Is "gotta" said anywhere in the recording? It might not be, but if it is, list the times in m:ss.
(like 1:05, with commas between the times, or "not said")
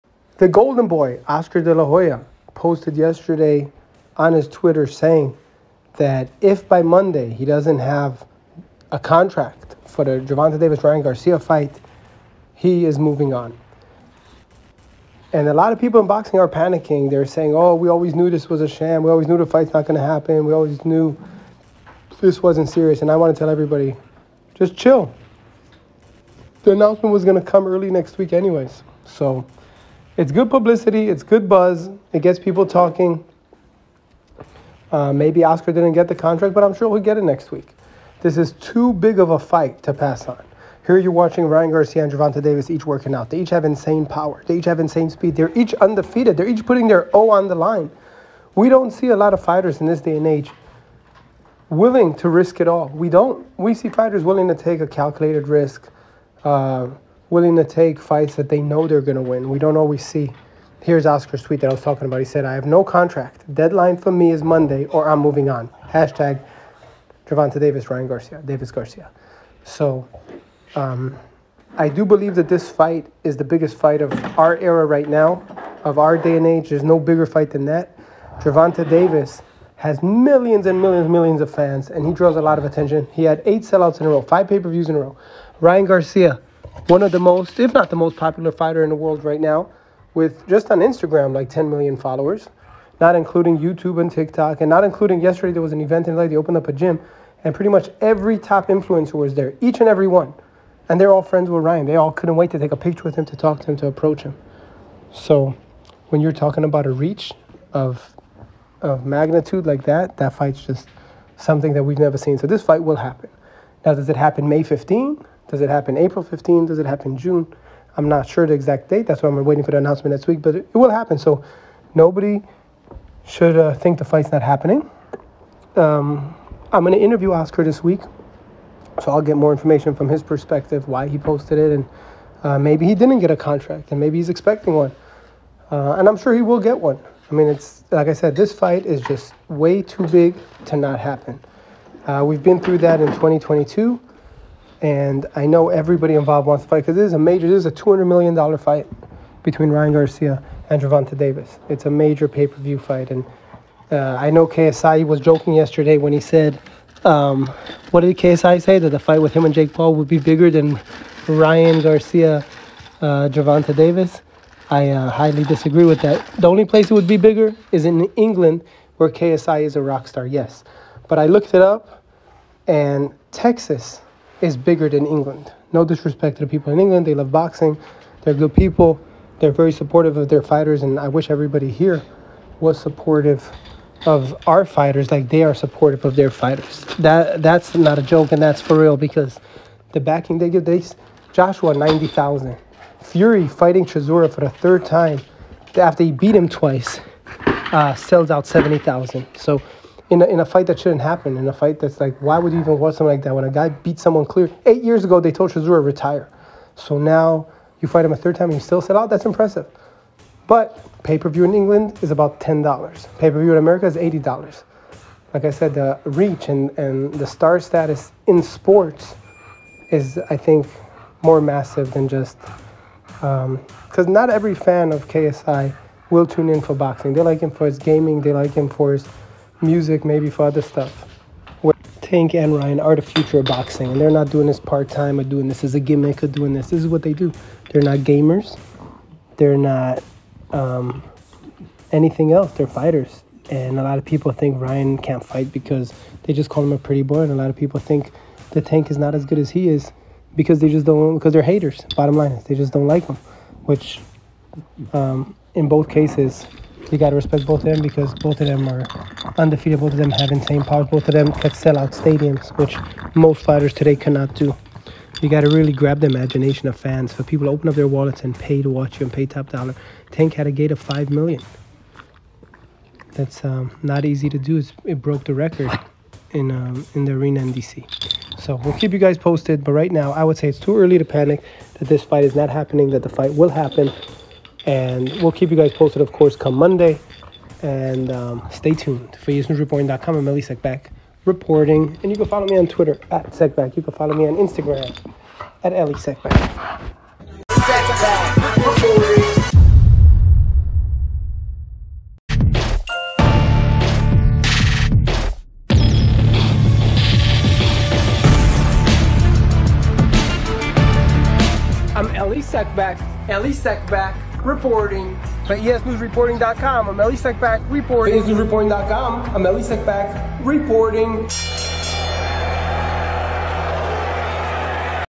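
4:16, 4:25.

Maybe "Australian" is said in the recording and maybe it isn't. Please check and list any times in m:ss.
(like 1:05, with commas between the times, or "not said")
not said.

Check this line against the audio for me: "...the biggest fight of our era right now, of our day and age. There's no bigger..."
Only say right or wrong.
right.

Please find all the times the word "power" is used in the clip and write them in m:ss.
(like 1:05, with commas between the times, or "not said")
0:44, 4:20.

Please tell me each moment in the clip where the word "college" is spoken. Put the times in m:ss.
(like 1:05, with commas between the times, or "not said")
not said.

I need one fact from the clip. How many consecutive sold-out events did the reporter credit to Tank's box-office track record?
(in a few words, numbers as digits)
8.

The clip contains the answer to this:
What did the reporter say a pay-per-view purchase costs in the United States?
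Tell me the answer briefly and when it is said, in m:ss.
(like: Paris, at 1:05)
$80, at 3:33.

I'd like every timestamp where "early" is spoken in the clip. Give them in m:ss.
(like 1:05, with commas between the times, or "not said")
0:27, 4:40.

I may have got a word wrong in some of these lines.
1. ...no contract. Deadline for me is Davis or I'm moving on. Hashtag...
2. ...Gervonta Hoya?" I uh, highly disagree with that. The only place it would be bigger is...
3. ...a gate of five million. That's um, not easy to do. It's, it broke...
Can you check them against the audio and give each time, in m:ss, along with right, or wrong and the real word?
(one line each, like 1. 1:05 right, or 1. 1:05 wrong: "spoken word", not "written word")
1. 1:02 wrong: "Monday", not "Davis"
2. 2:43 wrong: "Davis", not "Hoya"
3. 4:30 right.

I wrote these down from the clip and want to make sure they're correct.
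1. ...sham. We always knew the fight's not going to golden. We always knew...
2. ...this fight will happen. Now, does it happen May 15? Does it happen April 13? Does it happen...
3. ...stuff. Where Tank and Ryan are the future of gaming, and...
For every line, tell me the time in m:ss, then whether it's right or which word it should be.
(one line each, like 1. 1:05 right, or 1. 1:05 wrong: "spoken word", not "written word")
1. 0:18 wrong: "happen", not "golden"
2. 1:52 wrong: "15", not "13"
3. 3:50 wrong: "boxing", not "gaming".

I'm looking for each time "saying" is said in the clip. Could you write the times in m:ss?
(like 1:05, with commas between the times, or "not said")
0:04, 0:17.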